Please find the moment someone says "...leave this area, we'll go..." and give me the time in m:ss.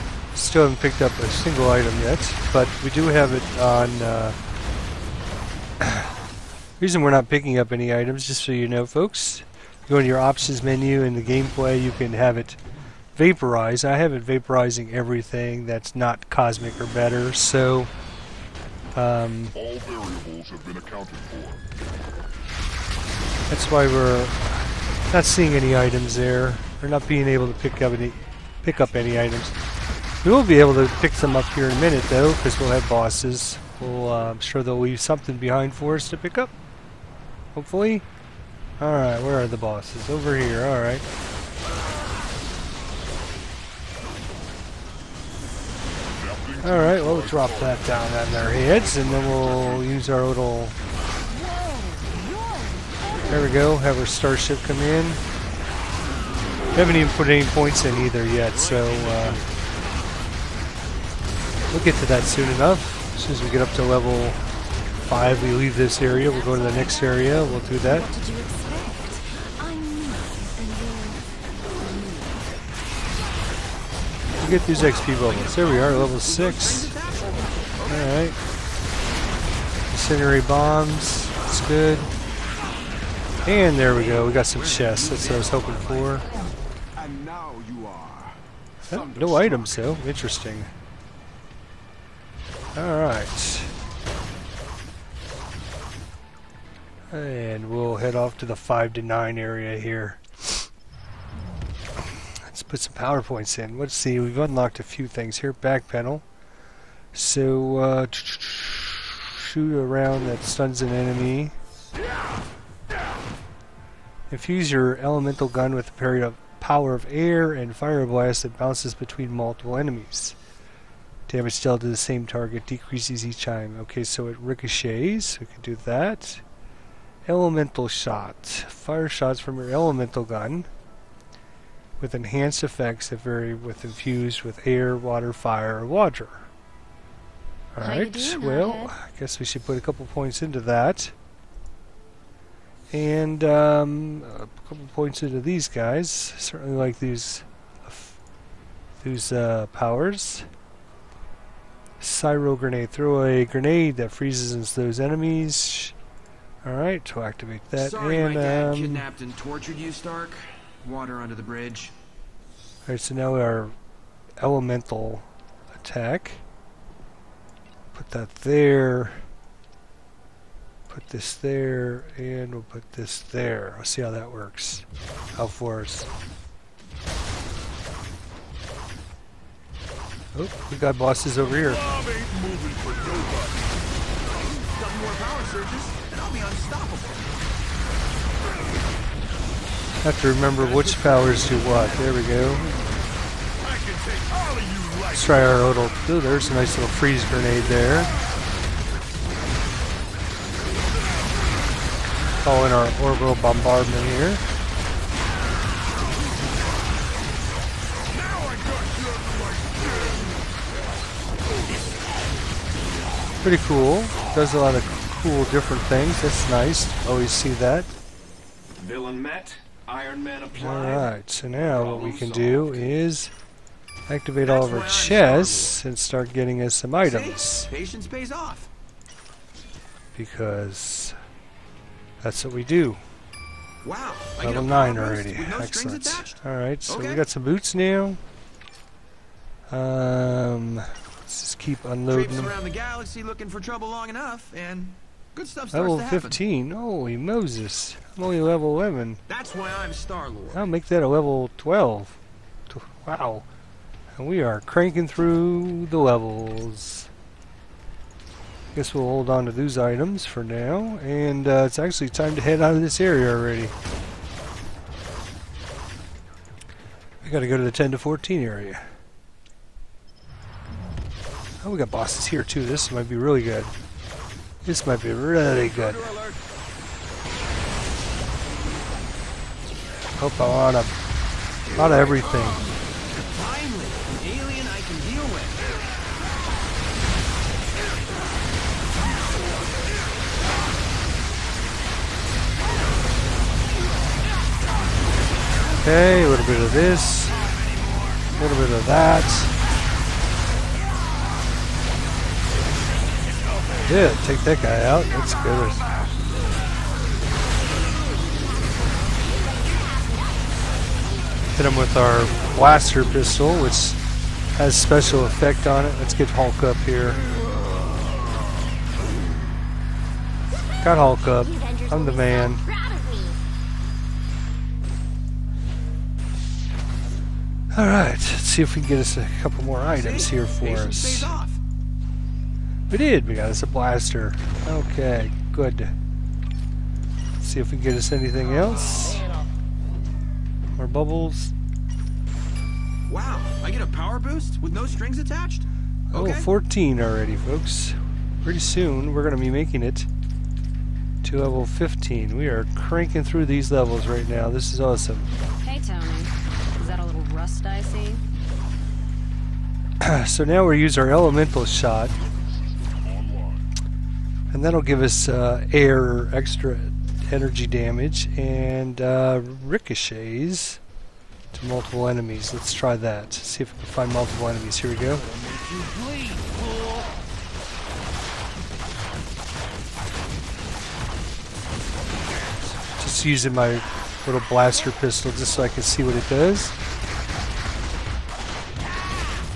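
1:05.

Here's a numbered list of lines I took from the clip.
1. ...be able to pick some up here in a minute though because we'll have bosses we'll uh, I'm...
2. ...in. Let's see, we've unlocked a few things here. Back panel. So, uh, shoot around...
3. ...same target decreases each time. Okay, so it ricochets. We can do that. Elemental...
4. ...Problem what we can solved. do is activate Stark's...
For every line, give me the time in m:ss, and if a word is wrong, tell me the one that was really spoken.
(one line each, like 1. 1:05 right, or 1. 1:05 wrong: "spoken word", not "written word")
1. 0:30 right
2. 1:43 right
3. 2:01 right
4. 3:41 wrong: "That", not "Stark".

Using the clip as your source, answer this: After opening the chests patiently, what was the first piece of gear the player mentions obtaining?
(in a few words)
Boots.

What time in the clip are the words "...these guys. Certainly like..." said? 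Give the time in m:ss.
2:25.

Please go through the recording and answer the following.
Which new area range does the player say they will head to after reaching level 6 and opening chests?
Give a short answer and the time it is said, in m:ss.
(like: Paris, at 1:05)
5 to 9, at 1:38.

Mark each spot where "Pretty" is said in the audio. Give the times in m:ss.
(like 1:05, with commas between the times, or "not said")
3:33, 5:48.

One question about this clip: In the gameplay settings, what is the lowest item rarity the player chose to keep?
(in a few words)
Cosmic.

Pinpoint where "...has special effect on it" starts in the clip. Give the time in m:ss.
5:14.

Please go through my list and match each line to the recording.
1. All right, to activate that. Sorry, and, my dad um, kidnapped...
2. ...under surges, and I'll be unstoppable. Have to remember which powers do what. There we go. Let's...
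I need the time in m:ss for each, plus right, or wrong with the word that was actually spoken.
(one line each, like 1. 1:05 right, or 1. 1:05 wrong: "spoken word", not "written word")
1. 2:36 right
2. 3:05 wrong: "power", not "under".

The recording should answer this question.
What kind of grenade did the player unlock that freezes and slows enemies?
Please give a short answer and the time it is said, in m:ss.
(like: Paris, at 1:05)
Cryo grenade, at 2:31.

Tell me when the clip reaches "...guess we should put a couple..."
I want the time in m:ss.
2:19.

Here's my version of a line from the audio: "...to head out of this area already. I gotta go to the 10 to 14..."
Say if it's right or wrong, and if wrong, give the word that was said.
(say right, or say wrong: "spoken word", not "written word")
right.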